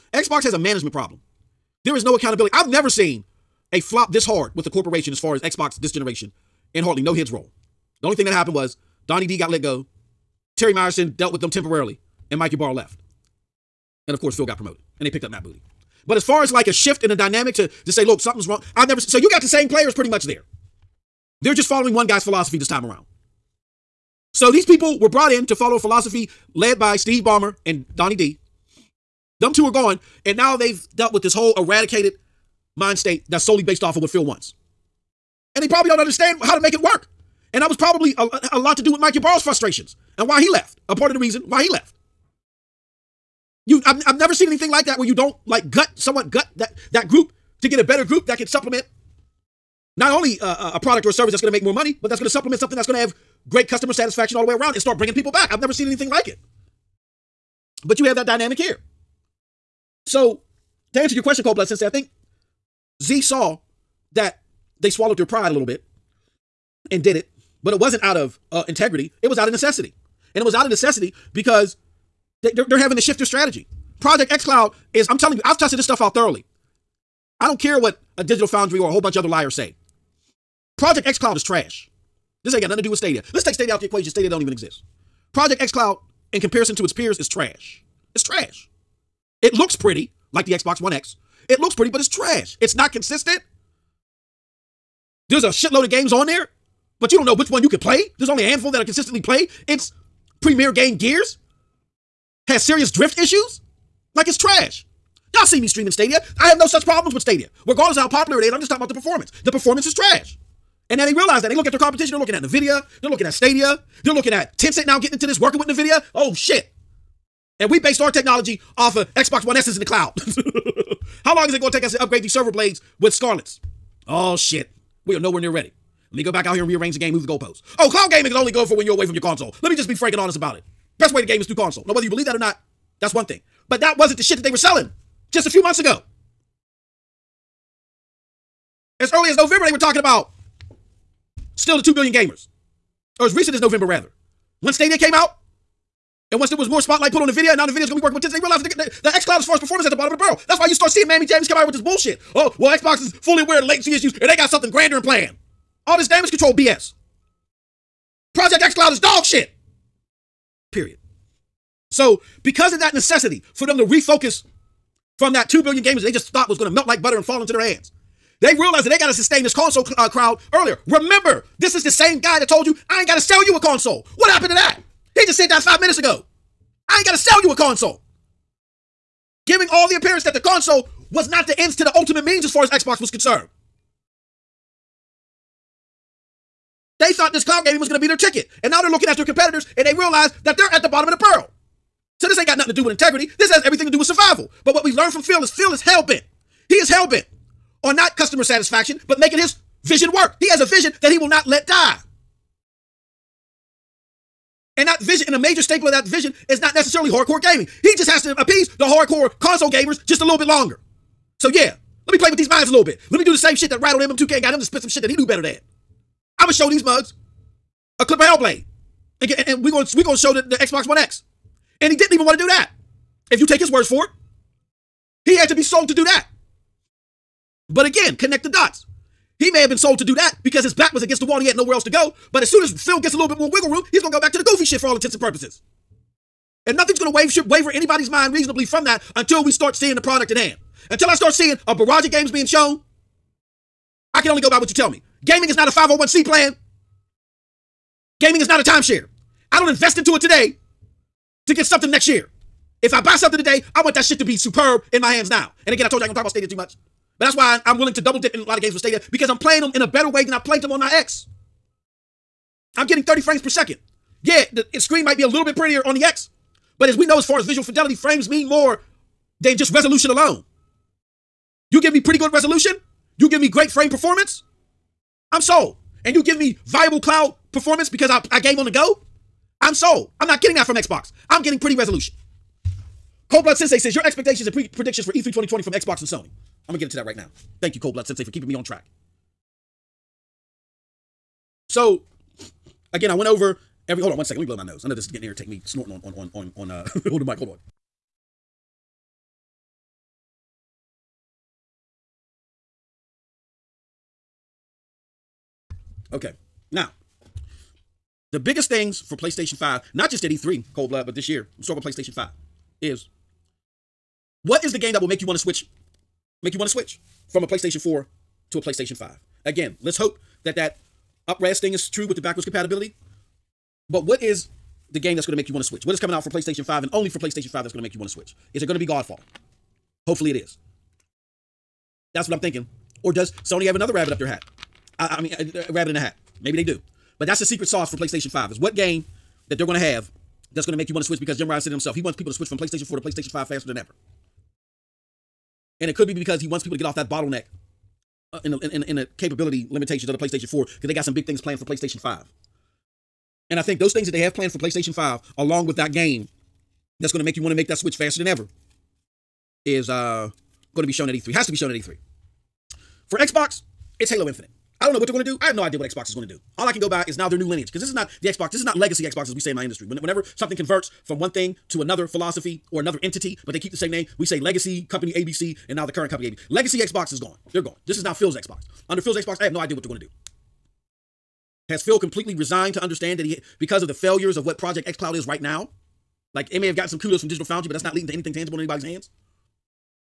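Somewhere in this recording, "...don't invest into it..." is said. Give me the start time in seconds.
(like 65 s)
249 s.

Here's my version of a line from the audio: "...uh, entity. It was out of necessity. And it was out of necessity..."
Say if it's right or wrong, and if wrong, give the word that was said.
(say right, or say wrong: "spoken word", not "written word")
wrong: "integrity", not "entity".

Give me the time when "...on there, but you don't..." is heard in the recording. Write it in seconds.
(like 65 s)
96 s.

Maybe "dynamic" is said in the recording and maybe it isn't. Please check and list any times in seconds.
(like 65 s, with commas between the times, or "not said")
17 s, 58 s.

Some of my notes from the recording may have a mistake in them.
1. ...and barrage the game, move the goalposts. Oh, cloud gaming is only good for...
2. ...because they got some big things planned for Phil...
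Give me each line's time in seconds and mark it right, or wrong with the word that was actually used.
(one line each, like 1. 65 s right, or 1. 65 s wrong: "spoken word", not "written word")
1. 126 s wrong: "rearrange", not "barrage"
2. 350 s wrong: "PlayStation", not "Phil".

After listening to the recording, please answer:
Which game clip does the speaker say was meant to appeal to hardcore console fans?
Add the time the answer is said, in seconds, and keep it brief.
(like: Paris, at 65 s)
Hellblade, at 218 s.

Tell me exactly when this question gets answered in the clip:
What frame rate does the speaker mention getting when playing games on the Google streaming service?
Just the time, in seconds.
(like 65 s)
263 s.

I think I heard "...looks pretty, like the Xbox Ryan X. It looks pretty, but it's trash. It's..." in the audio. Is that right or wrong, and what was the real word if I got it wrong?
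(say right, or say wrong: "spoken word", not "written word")
wrong: "One", not "Ryan".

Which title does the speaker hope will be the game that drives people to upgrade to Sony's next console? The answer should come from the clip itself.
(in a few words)
Godfall.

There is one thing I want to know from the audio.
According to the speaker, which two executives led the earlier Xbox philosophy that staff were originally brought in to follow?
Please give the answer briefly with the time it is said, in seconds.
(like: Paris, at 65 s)
Steve Ballmer and Donnie D, at 26 s.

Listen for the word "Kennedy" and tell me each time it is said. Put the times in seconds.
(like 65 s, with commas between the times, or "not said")
not said.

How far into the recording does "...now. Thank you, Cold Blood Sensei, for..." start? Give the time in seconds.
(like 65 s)
287 s.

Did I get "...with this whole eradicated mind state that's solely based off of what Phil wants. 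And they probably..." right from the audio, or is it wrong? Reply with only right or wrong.
right.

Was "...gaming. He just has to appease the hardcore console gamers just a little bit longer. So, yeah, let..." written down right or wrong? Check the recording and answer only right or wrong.
right.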